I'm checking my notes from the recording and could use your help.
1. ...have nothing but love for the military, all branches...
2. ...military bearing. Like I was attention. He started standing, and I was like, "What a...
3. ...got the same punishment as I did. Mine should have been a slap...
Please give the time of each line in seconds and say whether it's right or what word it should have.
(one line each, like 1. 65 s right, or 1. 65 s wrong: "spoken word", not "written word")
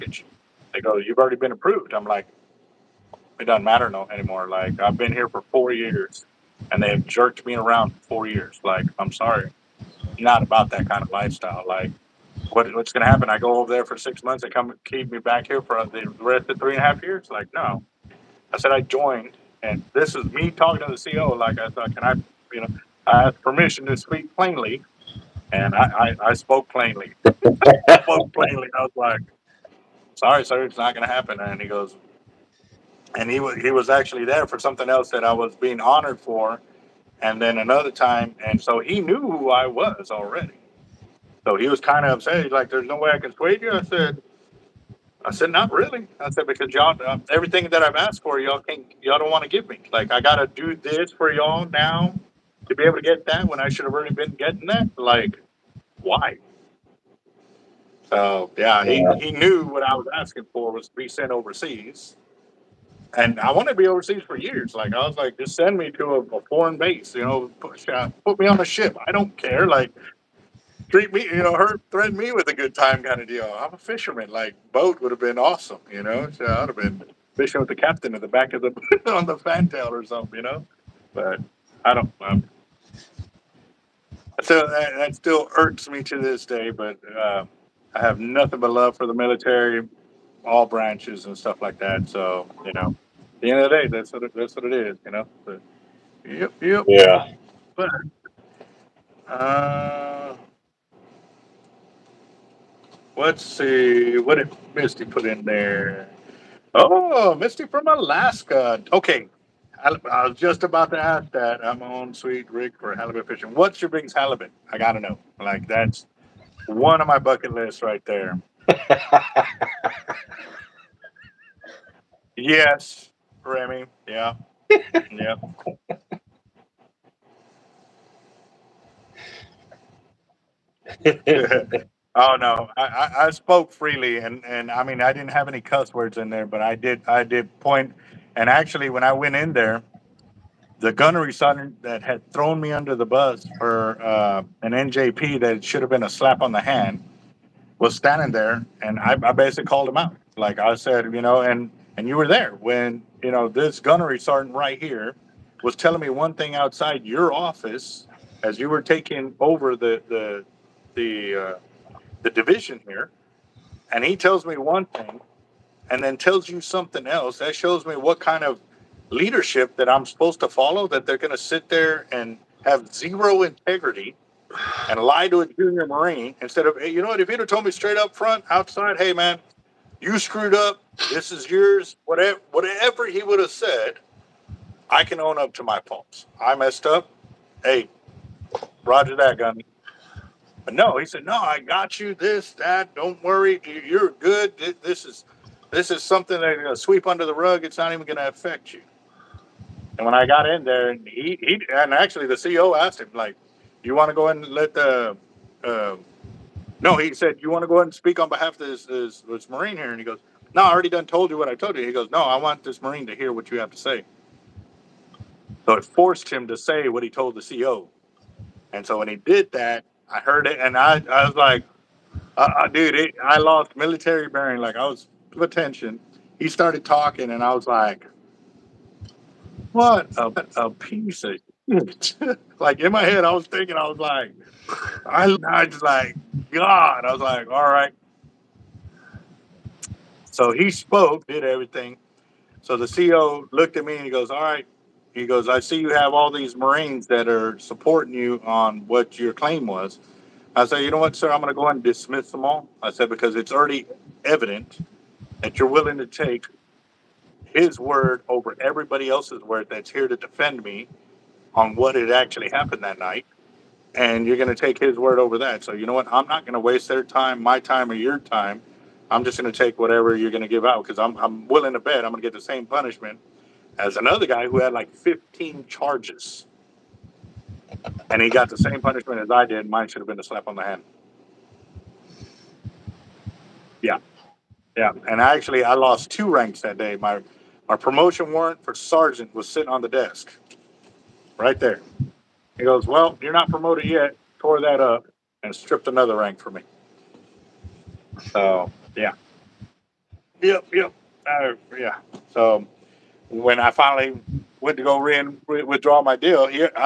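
1. 87 s right
2. 223 s wrong: "talking", not "standing"
3. 278 s right.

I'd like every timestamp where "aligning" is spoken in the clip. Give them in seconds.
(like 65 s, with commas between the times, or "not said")
not said.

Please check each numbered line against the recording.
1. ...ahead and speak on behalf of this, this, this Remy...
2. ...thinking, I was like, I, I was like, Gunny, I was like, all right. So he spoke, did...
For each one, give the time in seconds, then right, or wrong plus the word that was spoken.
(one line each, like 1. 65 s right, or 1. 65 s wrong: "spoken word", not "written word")
1. 207 s wrong: "Marine", not "Remy"
2. 233 s wrong: "God", not "Gunny".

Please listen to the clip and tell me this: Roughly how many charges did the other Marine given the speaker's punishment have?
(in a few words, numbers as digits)
15.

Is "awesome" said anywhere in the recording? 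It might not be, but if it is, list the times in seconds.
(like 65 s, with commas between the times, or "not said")
75 s.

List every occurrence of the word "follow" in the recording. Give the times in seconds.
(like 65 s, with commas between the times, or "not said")
170 s.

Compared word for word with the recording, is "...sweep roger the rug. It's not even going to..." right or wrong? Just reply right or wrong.
wrong.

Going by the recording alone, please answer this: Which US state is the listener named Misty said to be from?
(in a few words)
Alaska.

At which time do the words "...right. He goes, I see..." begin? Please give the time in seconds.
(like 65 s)
244 s.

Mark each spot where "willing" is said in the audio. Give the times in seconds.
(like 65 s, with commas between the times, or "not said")
255 s, 271 s.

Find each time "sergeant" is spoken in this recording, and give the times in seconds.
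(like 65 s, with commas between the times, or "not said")
141 s, 154 s, 288 s.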